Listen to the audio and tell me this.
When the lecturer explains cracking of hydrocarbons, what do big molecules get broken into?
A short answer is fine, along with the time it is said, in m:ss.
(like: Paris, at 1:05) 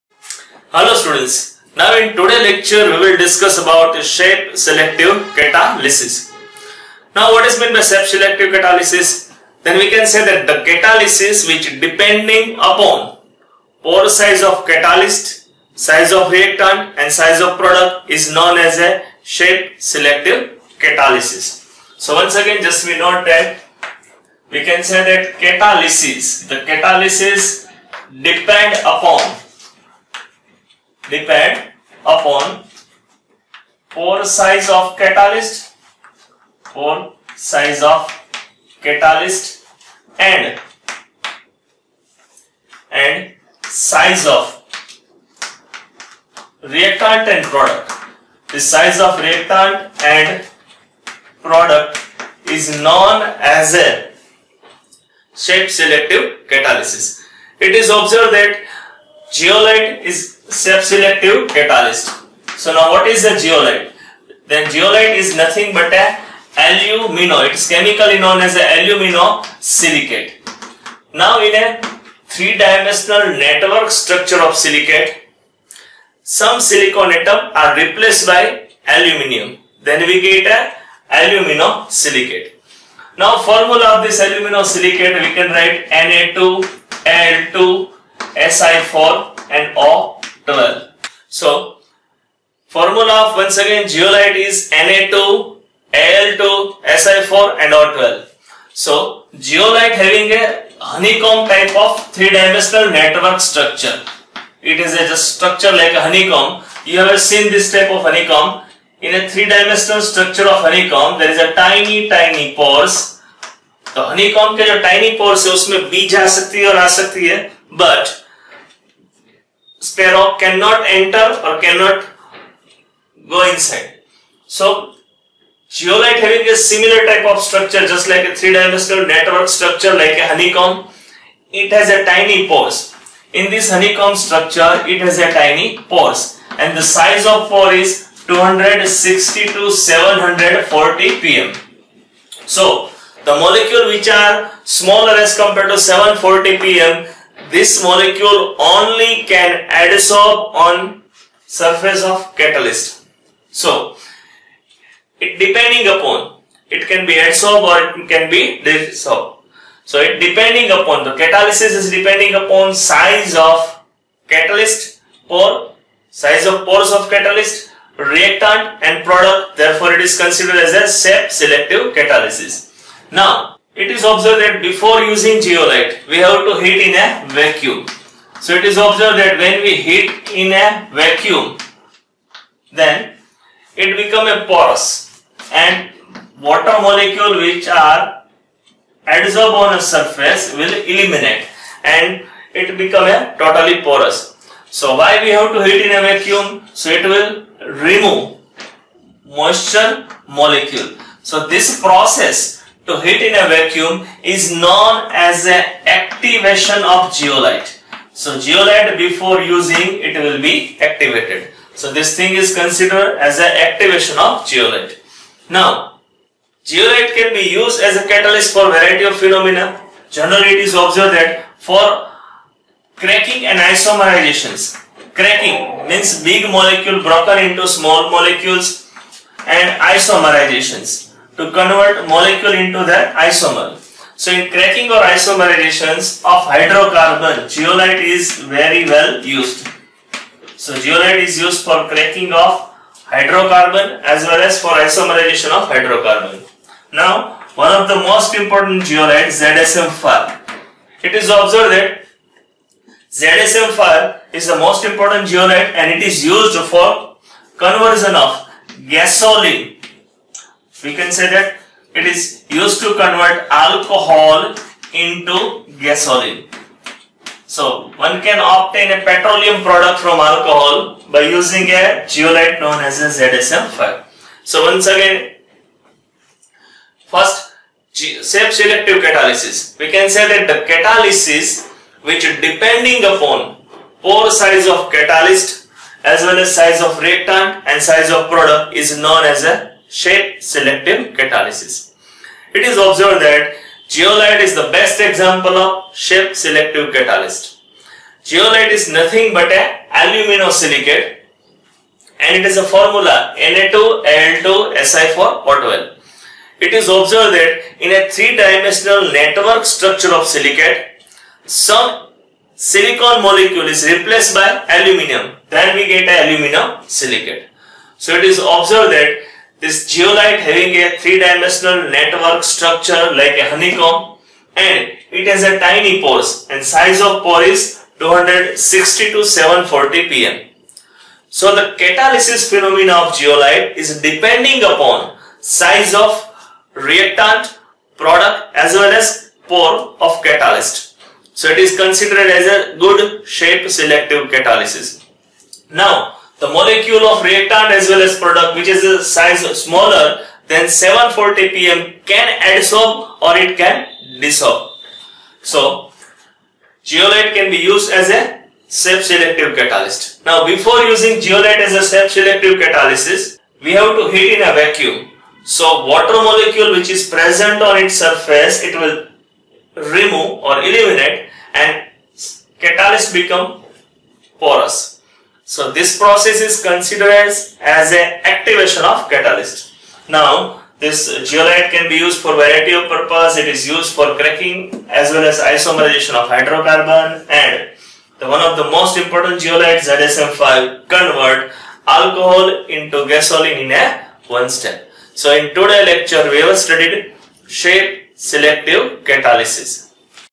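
small molecules, at 3:47.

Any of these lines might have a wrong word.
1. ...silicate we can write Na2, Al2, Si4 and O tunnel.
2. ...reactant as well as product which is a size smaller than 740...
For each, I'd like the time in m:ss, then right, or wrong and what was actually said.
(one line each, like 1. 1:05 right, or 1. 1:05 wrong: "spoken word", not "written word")
1. 1:24 right
2. 5:47 right.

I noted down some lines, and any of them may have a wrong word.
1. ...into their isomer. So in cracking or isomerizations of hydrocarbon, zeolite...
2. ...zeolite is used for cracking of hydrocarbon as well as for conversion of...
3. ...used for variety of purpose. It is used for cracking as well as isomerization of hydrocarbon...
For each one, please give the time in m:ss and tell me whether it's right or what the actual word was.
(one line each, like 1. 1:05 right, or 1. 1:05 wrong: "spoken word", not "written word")
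1. 3:52 right
2. 4:00 wrong: "isomerization", not "conversion"
3. 6:21 right.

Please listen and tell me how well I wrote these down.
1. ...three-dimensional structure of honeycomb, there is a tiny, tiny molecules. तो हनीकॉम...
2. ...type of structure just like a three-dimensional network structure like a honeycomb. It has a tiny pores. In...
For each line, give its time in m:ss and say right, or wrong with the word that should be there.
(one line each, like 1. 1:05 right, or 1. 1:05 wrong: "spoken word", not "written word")
1. 1:49 wrong: "pores", not "molecules"
2. 2:07 right.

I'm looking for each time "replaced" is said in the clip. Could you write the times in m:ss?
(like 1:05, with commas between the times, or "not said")
1:17, 5:13.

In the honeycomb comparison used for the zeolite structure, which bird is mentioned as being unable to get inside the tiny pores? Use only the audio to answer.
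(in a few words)
sparrow.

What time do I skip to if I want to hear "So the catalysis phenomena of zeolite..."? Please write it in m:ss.
5:31.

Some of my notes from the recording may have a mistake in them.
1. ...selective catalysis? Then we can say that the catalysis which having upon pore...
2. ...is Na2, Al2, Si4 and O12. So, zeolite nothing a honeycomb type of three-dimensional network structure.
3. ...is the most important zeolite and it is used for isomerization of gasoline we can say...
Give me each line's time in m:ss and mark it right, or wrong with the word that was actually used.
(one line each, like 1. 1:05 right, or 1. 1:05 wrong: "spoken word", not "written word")
1. 0:08 wrong: "depending", not "having"
2. 1:34 wrong: "having", not "nothing"
3. 4:14 wrong: "conversion", not "isomerization".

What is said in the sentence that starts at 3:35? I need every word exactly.
Now zeolite can be used as a catalyst for variety of phenomena.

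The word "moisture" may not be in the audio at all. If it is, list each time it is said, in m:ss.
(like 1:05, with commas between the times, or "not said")
3:19.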